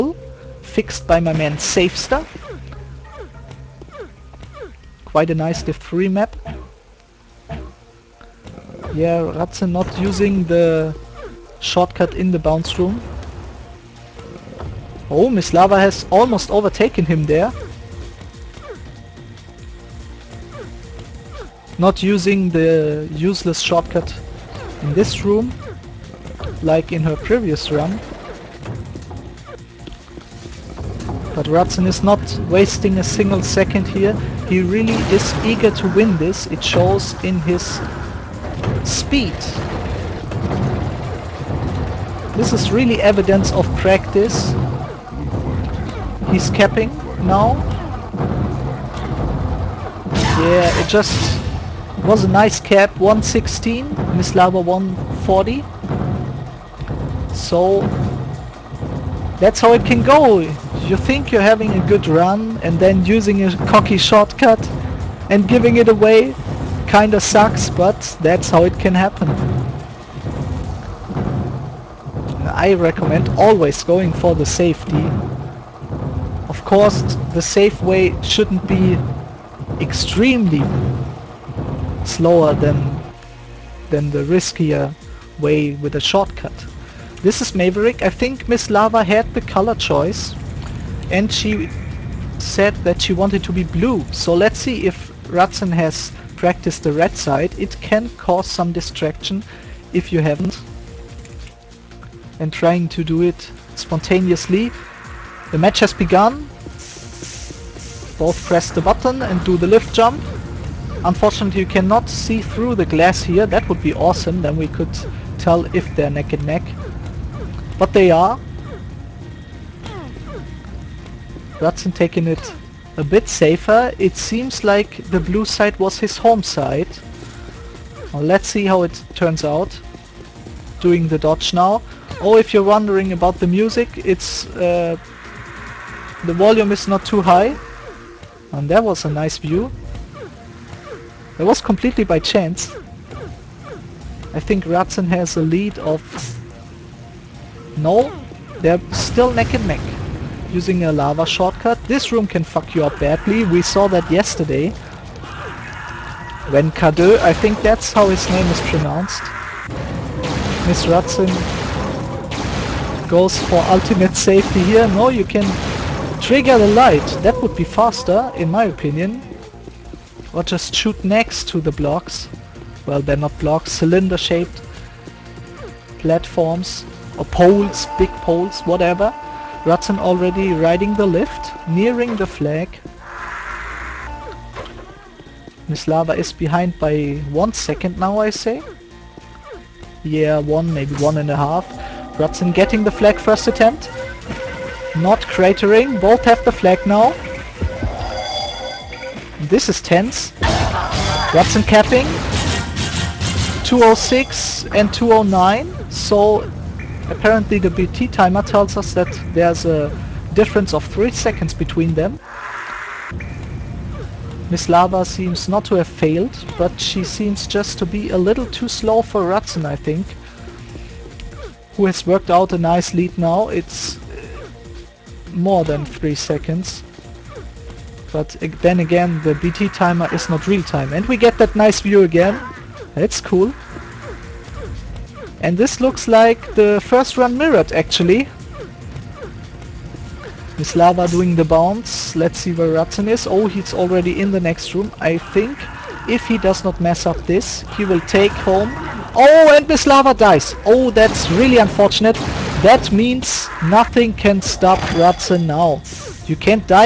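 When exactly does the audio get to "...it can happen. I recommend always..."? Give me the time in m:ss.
1:08.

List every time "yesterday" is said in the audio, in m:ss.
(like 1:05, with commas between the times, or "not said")
2:34.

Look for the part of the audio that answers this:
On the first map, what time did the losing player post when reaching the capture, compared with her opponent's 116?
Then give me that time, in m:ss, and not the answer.
0:54.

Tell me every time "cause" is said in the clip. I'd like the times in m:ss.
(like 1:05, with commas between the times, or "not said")
1:38.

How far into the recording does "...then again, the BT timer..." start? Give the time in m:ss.
3:48.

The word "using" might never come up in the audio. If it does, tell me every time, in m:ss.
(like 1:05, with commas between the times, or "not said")
0:09, 0:22, 1:03, 2:30.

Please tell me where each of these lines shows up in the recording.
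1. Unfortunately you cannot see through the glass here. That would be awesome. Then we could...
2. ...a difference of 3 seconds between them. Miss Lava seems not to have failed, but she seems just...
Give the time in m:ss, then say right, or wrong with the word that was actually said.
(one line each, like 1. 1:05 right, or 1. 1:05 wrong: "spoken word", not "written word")
1. 1:51 right
2. 3:29 right.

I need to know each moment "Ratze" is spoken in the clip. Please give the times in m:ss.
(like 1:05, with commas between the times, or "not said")
0:09.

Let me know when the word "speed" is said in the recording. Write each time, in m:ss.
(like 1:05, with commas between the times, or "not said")
0:38.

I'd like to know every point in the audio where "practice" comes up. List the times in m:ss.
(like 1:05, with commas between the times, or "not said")
0:43, 1:36.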